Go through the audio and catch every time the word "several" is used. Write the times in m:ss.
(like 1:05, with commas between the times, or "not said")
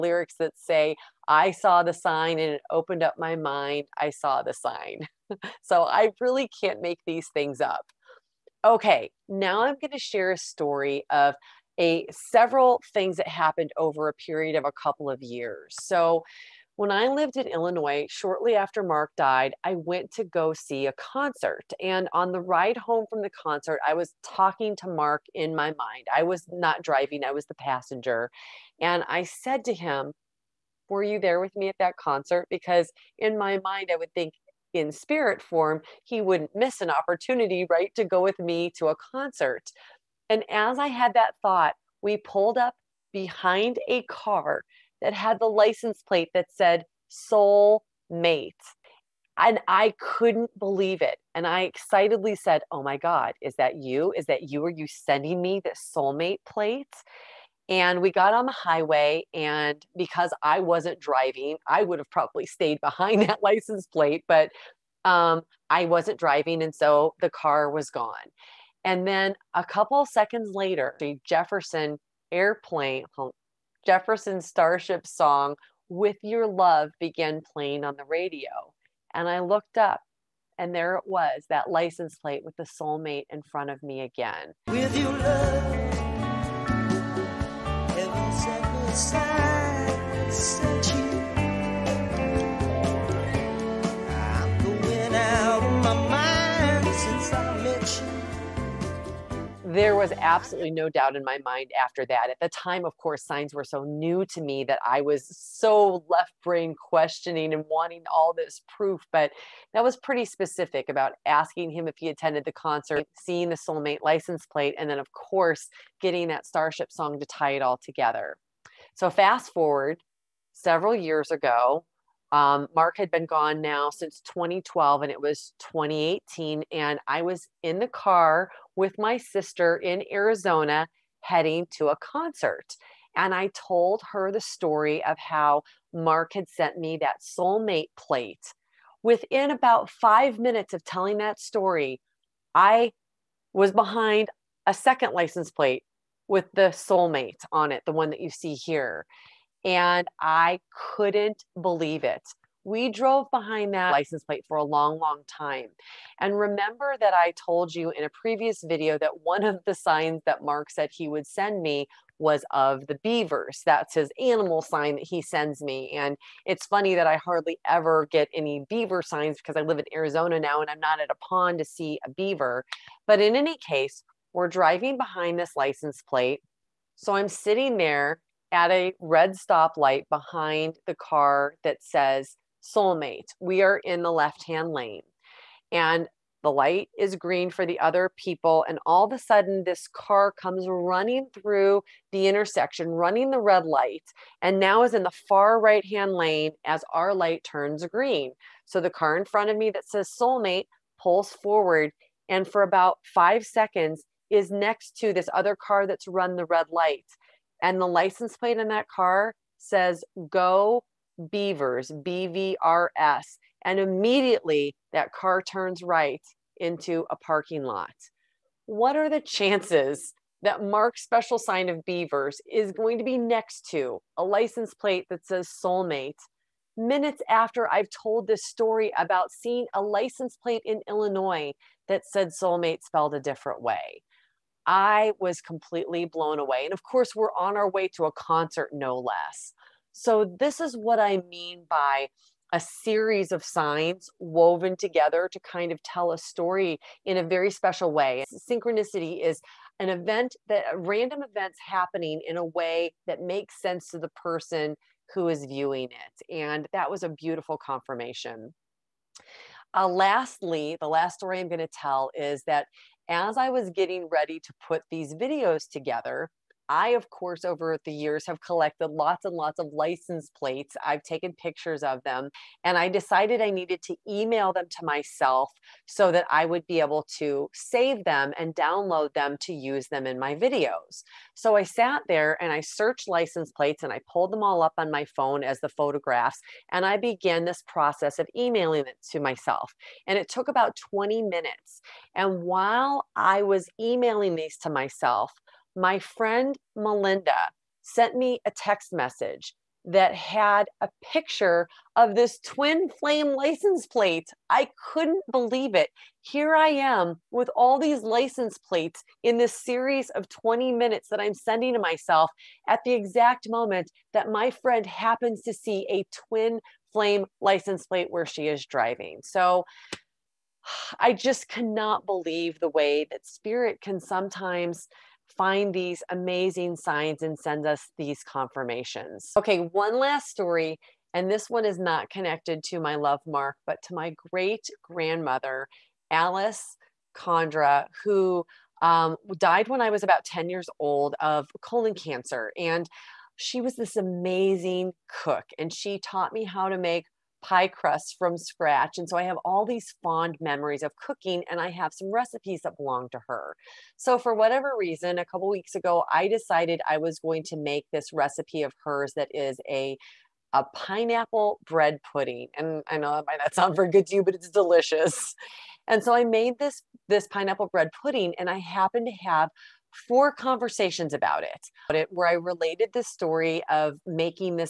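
0:12, 2:00.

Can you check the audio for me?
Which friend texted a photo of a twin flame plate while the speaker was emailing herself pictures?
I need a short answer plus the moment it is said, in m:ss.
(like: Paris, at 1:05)
Melinda, at 4:56.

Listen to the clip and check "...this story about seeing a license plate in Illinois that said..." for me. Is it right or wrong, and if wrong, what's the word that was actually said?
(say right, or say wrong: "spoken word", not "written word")
right.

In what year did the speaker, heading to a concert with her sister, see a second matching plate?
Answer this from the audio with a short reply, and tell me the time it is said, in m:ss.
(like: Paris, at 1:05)
2018, at 2:05.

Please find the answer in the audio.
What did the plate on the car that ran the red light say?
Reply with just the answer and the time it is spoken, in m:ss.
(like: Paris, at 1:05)
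Go Beavers, at 3:30.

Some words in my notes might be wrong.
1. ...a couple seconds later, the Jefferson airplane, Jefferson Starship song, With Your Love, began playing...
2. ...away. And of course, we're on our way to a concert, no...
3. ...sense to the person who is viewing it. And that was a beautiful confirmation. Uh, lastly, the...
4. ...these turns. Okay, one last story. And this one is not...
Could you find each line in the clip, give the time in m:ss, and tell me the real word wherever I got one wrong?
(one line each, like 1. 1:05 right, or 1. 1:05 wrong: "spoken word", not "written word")
1. 1:09 right
2. 3:56 right
3. 4:13 right
4. 5:27 wrong: "confirmations", not "turns".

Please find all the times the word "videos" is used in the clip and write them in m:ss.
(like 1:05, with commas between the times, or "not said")
2:38, 4:25, 4:40.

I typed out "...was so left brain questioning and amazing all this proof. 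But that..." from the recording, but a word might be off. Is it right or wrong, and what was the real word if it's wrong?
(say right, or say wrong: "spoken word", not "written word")
wrong: "wanting", not "amazing".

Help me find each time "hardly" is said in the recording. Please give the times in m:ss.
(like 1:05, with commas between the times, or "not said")
2:47.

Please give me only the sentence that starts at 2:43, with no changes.
That's his animal sign that he sends me.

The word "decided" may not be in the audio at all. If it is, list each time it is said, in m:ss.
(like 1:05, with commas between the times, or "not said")
4:32, 5:56.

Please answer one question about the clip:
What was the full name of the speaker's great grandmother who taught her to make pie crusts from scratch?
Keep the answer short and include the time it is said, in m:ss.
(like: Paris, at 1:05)
Alice Condra, at 5:36.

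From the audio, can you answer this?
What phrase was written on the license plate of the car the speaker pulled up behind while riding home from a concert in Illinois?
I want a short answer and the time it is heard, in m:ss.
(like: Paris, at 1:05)
Soul mate, at 0:47.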